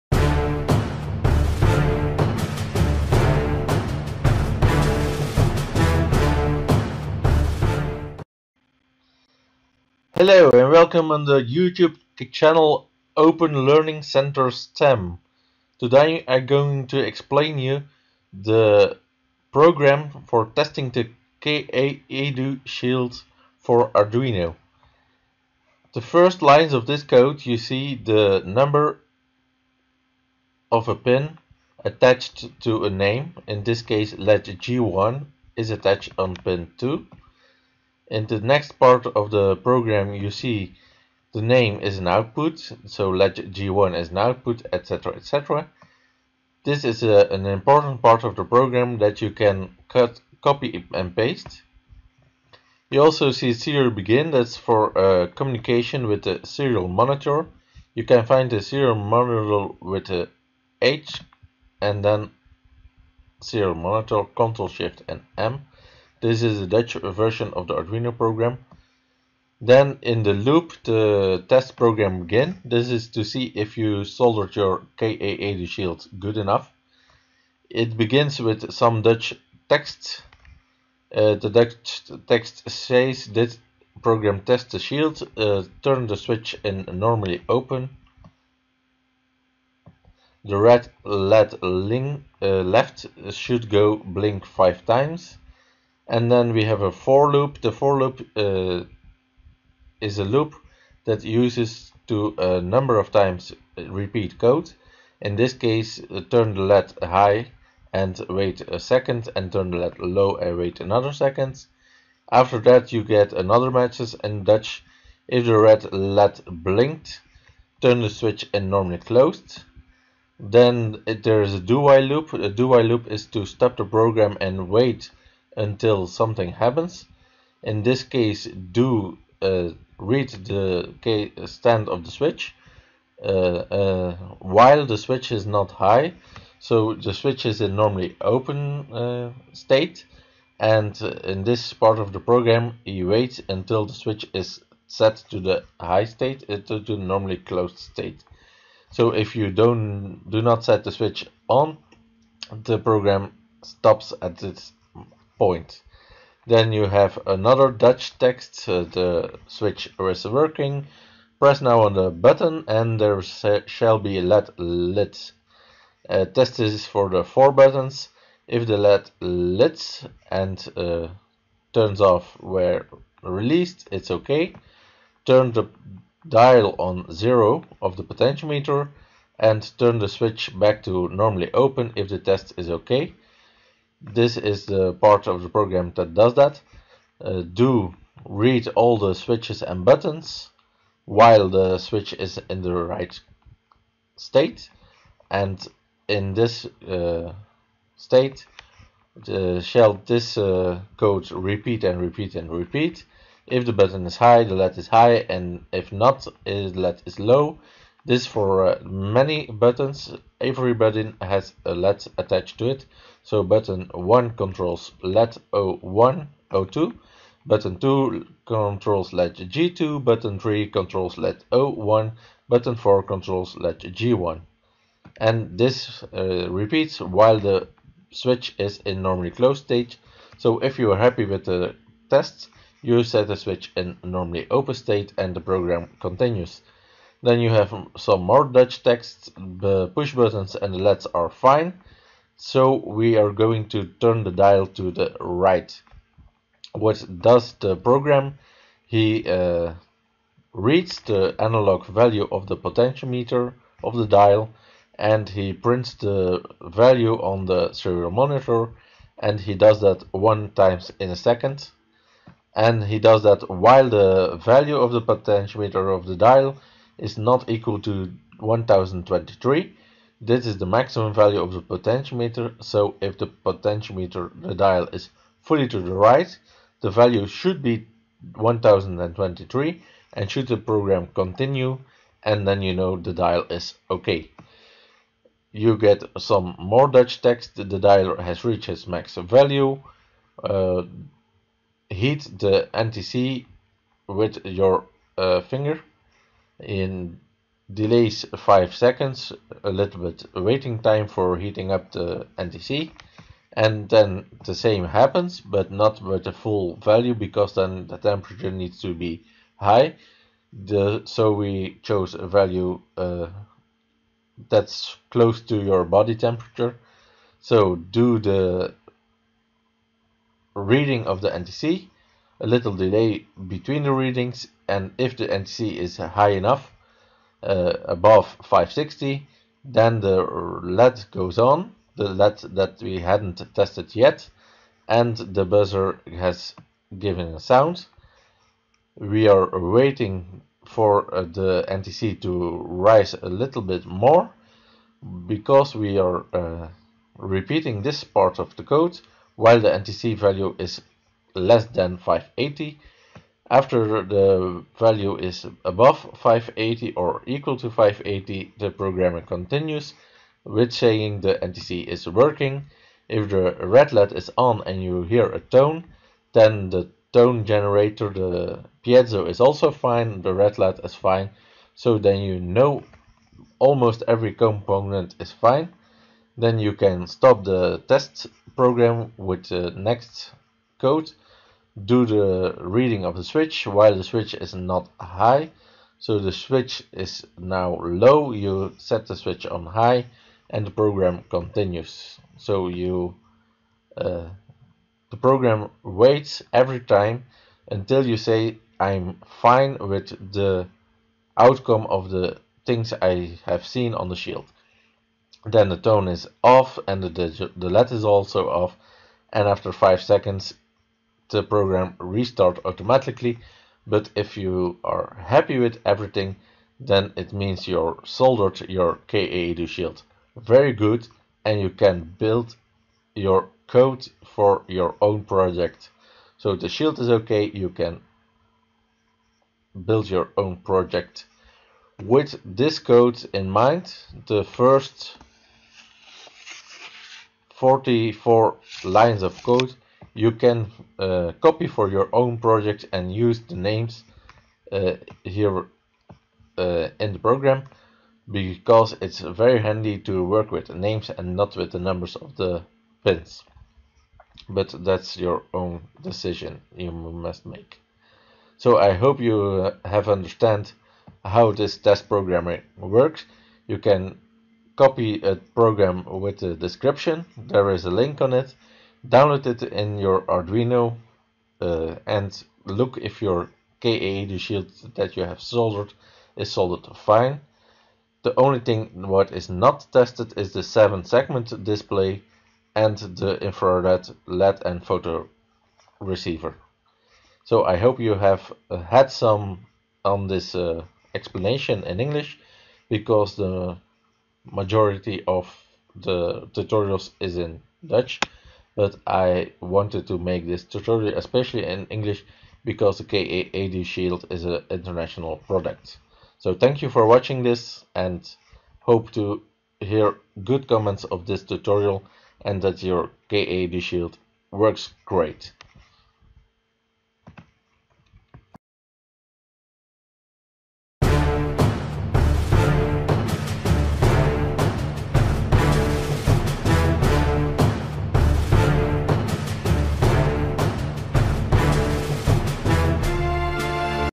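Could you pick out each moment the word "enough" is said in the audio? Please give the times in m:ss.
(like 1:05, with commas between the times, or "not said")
1:16, 5:26.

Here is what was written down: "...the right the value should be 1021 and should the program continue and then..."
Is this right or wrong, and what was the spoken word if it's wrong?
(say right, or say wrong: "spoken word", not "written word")
wrong: "1023", not "1021".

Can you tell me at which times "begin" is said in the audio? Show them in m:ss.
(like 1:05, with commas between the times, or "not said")
0:53, 1:17.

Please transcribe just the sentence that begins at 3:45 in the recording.
And this uh, repeats while the switch is in normally closed state.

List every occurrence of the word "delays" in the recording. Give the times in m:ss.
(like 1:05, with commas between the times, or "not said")
4:57, 5:22.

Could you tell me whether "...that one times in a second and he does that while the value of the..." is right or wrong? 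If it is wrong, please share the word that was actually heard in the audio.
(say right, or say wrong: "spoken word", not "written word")
right.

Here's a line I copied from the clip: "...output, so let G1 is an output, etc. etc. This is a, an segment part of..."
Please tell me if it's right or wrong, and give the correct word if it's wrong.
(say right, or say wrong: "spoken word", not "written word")
wrong: "important", not "segment".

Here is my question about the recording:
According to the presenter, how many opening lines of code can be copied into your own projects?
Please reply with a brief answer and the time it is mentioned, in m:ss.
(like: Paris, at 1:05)
44, at 7:17.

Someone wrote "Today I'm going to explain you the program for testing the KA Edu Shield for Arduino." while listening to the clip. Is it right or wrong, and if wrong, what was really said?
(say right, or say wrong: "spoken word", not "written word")
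right.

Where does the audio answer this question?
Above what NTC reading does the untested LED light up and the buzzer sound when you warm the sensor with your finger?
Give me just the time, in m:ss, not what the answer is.
5:27.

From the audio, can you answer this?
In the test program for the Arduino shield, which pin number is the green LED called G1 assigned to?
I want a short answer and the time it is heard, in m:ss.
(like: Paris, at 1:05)
2, at 0:36.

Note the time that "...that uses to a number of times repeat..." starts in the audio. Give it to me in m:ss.
1:41.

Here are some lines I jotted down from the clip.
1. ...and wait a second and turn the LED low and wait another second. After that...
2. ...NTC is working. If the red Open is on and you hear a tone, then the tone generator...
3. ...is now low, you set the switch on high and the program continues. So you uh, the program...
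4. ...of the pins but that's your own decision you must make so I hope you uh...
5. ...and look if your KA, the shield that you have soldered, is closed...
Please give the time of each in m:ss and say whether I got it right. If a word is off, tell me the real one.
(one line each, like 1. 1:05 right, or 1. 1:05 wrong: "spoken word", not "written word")
1. 1:47 right
2. 6:01 wrong: "LED", not "Open"
3. 6:26 right
4. 7:32 right
5. 7:52 wrong: "soldered", not "closed".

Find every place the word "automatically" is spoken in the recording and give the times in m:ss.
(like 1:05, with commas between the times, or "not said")
6:52.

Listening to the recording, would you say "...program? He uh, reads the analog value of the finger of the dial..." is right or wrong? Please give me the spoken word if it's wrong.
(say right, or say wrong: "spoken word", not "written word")
wrong: "potentiometer", not "finger".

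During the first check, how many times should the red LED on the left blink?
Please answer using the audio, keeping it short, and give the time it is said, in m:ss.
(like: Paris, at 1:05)
5 times, at 1:33.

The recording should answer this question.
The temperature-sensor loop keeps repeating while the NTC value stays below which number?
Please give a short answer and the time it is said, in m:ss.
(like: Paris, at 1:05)
580, at 5:51.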